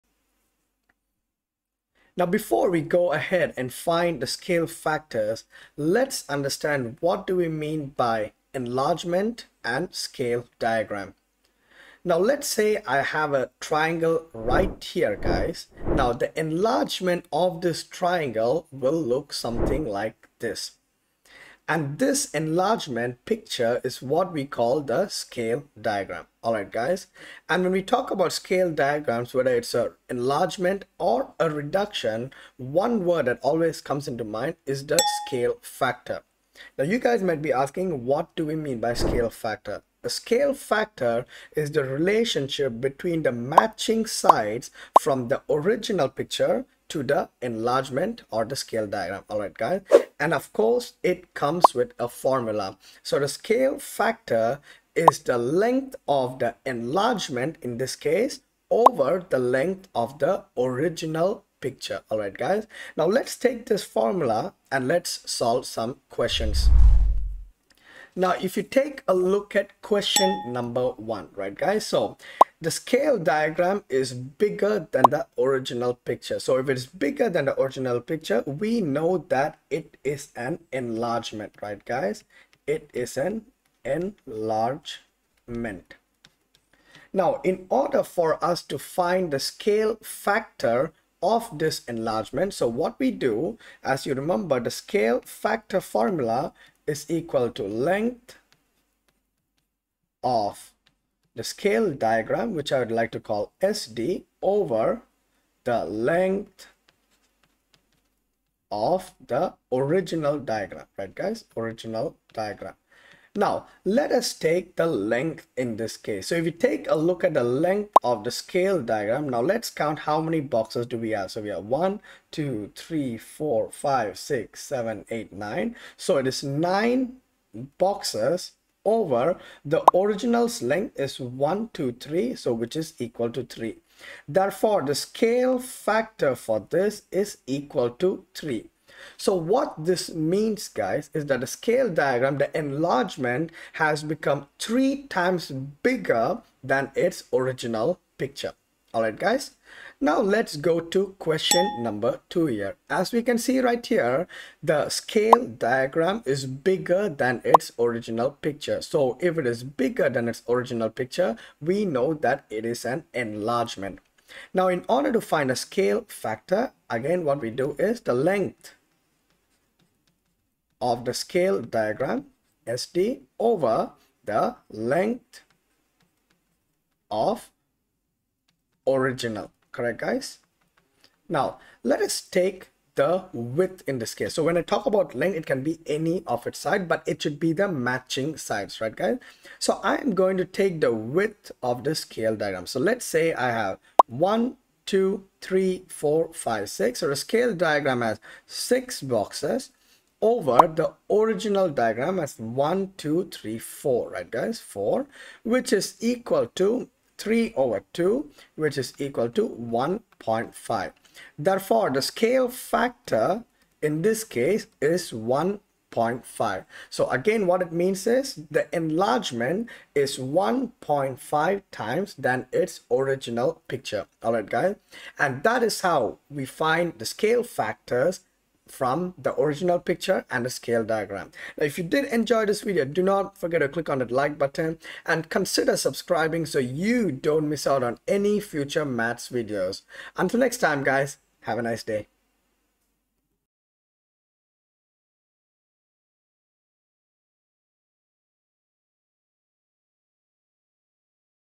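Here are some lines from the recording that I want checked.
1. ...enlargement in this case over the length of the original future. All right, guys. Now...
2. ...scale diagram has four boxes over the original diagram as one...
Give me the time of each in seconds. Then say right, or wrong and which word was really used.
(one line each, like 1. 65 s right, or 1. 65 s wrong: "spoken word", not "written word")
1. 56 s wrong: "picture", not "future"
2. 197 s wrong: "six", not "four".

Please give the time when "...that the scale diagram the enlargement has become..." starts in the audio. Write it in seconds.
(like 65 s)
141 s.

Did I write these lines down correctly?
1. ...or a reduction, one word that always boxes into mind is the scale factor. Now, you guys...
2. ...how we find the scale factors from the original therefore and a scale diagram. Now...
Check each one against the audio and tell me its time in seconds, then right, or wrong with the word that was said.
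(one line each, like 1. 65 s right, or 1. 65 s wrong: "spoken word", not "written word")
1. 30 s wrong: "comes", not "boxes"
2. 225 s wrong: "picture", not "therefore".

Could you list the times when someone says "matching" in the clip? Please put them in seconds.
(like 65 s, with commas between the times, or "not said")
43 s, 187 s.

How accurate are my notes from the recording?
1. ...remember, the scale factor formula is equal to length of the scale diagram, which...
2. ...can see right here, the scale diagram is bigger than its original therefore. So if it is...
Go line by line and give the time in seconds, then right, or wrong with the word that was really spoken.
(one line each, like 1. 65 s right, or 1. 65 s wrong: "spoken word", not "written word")
1. 94 s right
2. 153 s wrong: "picture", not "therefore".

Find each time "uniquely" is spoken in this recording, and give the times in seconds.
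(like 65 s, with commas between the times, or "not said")
not said.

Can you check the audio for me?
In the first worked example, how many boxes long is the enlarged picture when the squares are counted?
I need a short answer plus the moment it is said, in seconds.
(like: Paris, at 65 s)
9, at 126 s.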